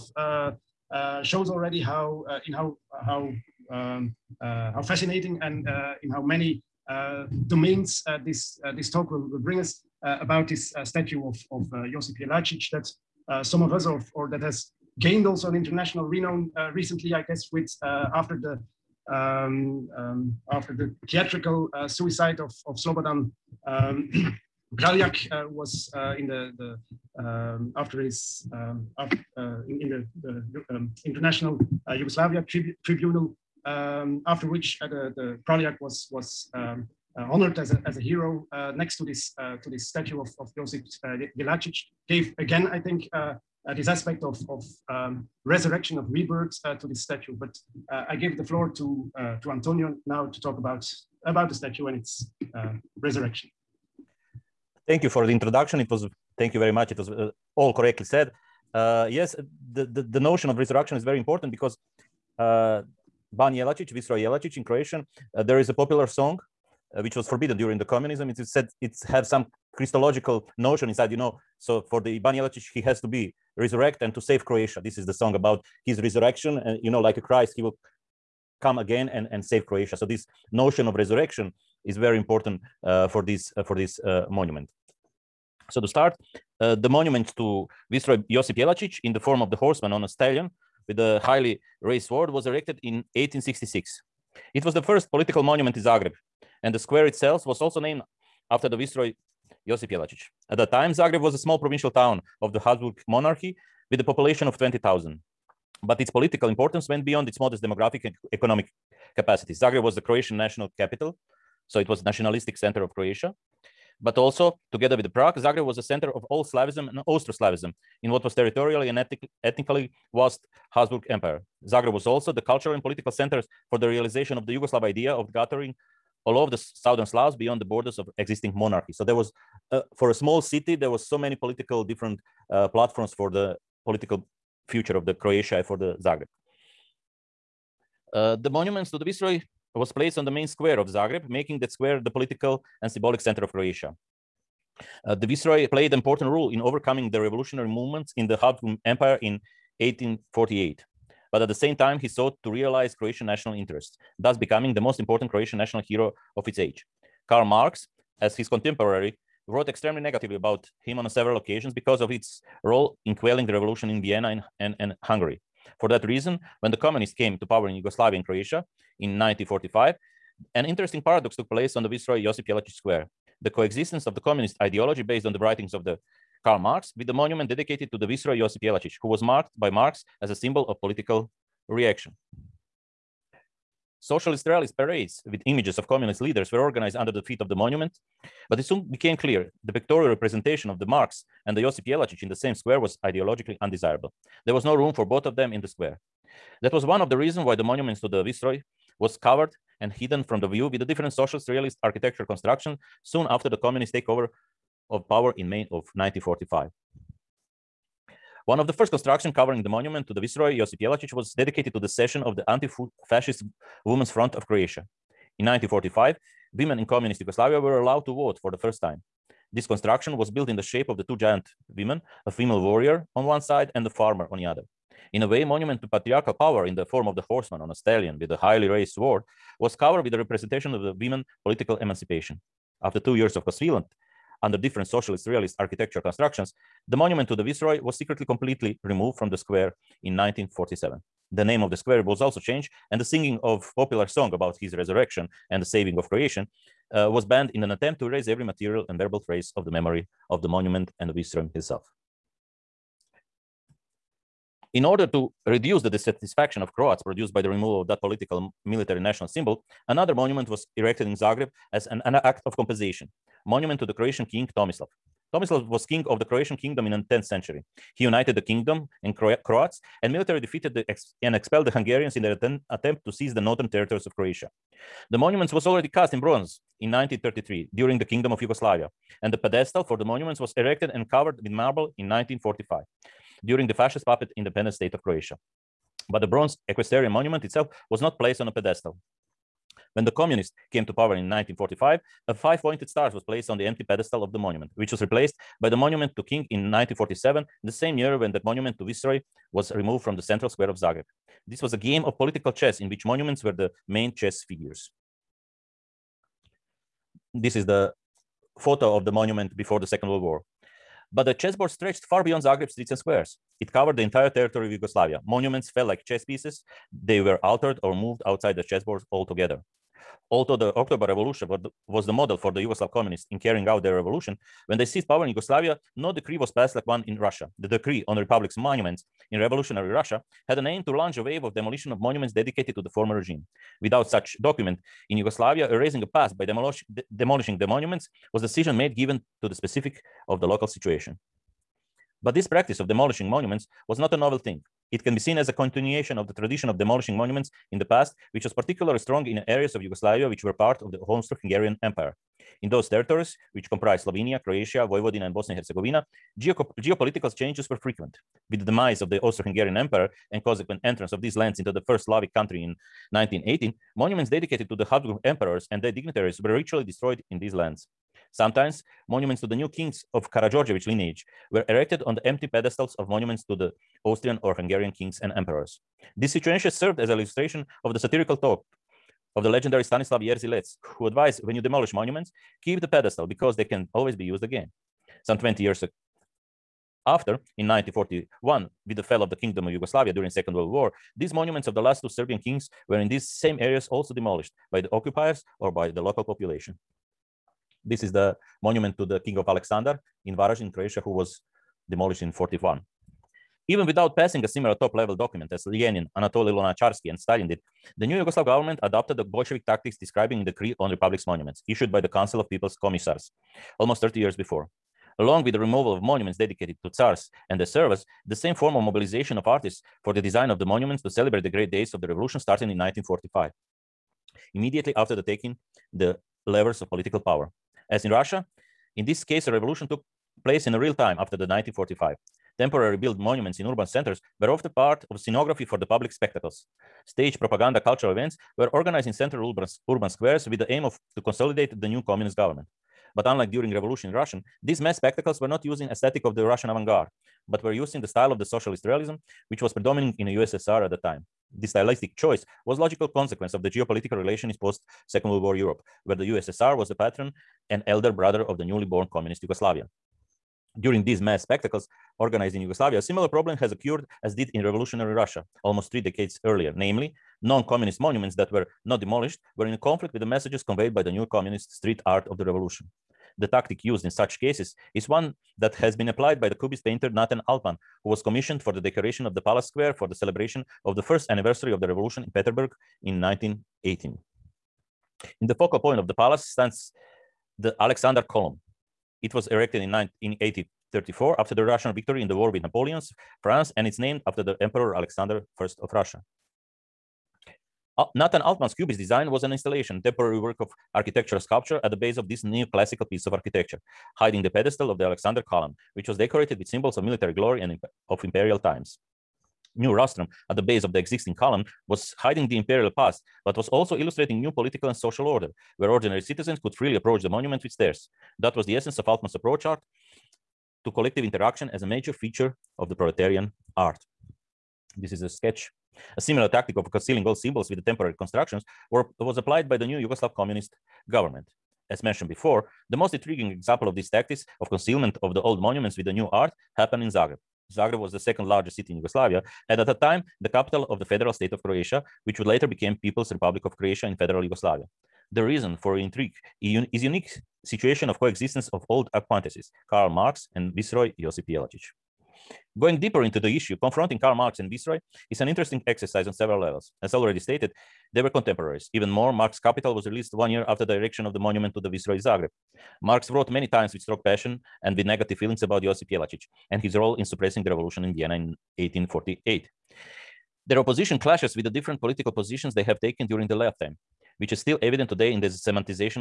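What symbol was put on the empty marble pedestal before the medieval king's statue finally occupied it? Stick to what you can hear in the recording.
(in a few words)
a five pointed star.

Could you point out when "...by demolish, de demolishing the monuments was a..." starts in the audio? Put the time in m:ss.
5:36.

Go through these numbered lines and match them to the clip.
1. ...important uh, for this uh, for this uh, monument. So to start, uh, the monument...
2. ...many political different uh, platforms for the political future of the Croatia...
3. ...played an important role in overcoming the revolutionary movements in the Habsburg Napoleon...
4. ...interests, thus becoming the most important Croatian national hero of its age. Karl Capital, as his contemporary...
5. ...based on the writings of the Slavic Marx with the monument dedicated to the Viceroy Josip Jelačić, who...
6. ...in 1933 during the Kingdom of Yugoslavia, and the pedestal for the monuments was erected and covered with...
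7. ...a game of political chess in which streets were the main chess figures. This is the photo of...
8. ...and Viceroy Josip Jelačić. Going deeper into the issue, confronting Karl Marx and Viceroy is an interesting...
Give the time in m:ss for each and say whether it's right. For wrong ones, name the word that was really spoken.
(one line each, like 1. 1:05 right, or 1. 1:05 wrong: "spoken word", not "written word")
1. 1:22 right
2. 2:11 right
3. 2:25 wrong: "Empire", not "Napoleon"
4. 2:33 wrong: "Marx", not "Capital"
5. 2:55 wrong: "Karl", not "Slavic"
6. 4:36 right
7. 5:01 wrong: "monuments", not "streets"
8. 9:10 right.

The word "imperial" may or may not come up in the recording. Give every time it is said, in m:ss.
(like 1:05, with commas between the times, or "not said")
8:28, 8:32.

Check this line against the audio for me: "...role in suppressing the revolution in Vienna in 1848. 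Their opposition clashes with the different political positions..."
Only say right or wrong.
right.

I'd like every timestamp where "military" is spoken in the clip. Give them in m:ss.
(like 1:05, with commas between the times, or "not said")
4:18, 4:30, 8:27.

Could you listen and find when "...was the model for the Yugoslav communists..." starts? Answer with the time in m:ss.
5:21.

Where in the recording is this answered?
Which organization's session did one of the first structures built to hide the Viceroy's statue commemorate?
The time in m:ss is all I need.
3:32.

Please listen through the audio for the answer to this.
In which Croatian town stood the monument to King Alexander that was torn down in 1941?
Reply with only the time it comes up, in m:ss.
6:40.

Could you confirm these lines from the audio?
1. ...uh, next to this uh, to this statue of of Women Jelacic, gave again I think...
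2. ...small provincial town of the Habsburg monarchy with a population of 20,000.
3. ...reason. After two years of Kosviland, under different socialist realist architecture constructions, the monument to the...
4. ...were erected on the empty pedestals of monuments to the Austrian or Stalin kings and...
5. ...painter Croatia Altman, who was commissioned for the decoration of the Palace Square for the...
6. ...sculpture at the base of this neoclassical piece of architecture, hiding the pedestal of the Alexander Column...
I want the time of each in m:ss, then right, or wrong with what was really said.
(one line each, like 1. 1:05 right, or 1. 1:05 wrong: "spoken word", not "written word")
1. 0:38 wrong: "Josip", not "Women"
2. 1:41 right
3. 3:51 wrong: "emancipation", not "reason"
4. 6:11 wrong: "Hungarian", not "Stalin"
5. 7:56 wrong: "Nathan", not "Croatia"
6. 8:21 right.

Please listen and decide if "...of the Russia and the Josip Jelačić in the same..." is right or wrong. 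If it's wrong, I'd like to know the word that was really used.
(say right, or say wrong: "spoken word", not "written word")
wrong: "Marx", not "Russia".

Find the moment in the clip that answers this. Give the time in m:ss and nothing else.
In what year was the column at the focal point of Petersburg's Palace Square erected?
8:09.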